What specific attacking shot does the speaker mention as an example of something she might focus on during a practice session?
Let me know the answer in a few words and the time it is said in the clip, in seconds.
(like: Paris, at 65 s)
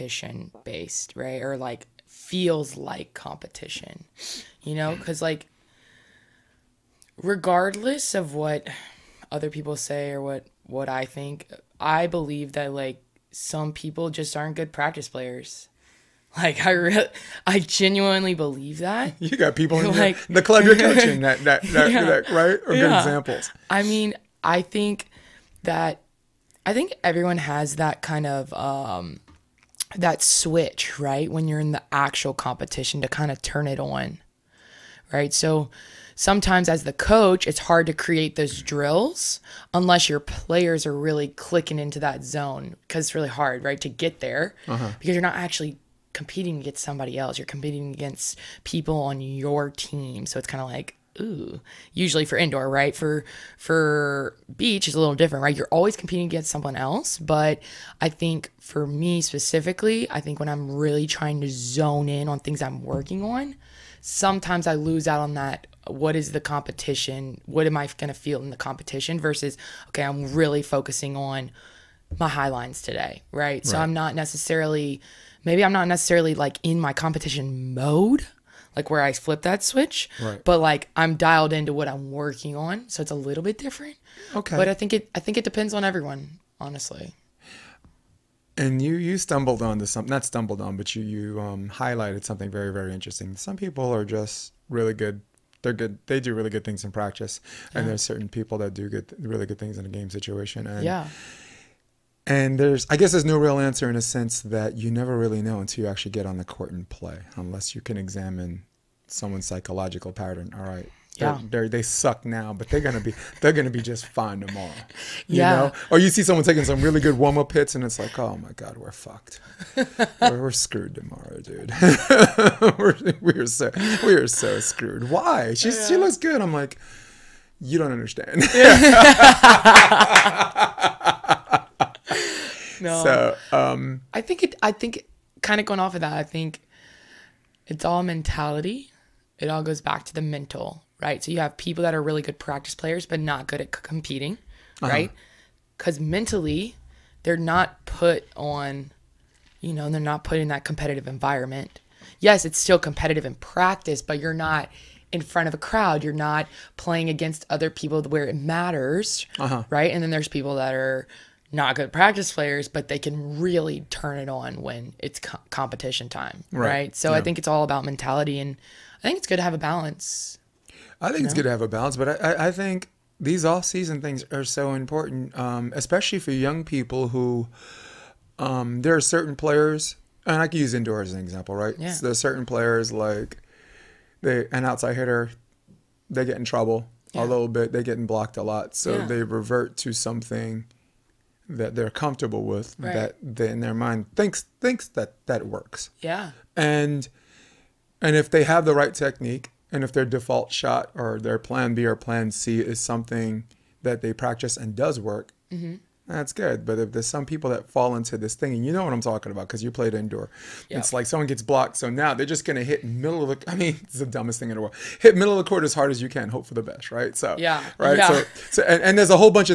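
High lines, at 72 s.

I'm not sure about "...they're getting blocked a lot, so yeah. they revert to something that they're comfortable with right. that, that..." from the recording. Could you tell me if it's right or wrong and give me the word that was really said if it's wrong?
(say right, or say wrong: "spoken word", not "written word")
right.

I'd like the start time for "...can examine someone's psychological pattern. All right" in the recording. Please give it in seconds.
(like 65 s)
107 s.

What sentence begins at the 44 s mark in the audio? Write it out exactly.
because you're not actually competing against somebody else.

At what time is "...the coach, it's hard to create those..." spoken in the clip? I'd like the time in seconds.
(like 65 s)
36 s.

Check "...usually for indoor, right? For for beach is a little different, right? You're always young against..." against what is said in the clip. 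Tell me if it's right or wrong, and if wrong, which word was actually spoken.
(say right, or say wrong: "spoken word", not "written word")
wrong: "competing", not "young".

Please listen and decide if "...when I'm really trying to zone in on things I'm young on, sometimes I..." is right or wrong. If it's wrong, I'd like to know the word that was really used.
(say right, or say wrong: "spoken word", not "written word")
wrong: "working", not "young".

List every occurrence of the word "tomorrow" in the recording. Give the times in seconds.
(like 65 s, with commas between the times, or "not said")
114 s, 120 s.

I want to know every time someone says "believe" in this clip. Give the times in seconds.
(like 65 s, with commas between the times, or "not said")
12 s, 18 s.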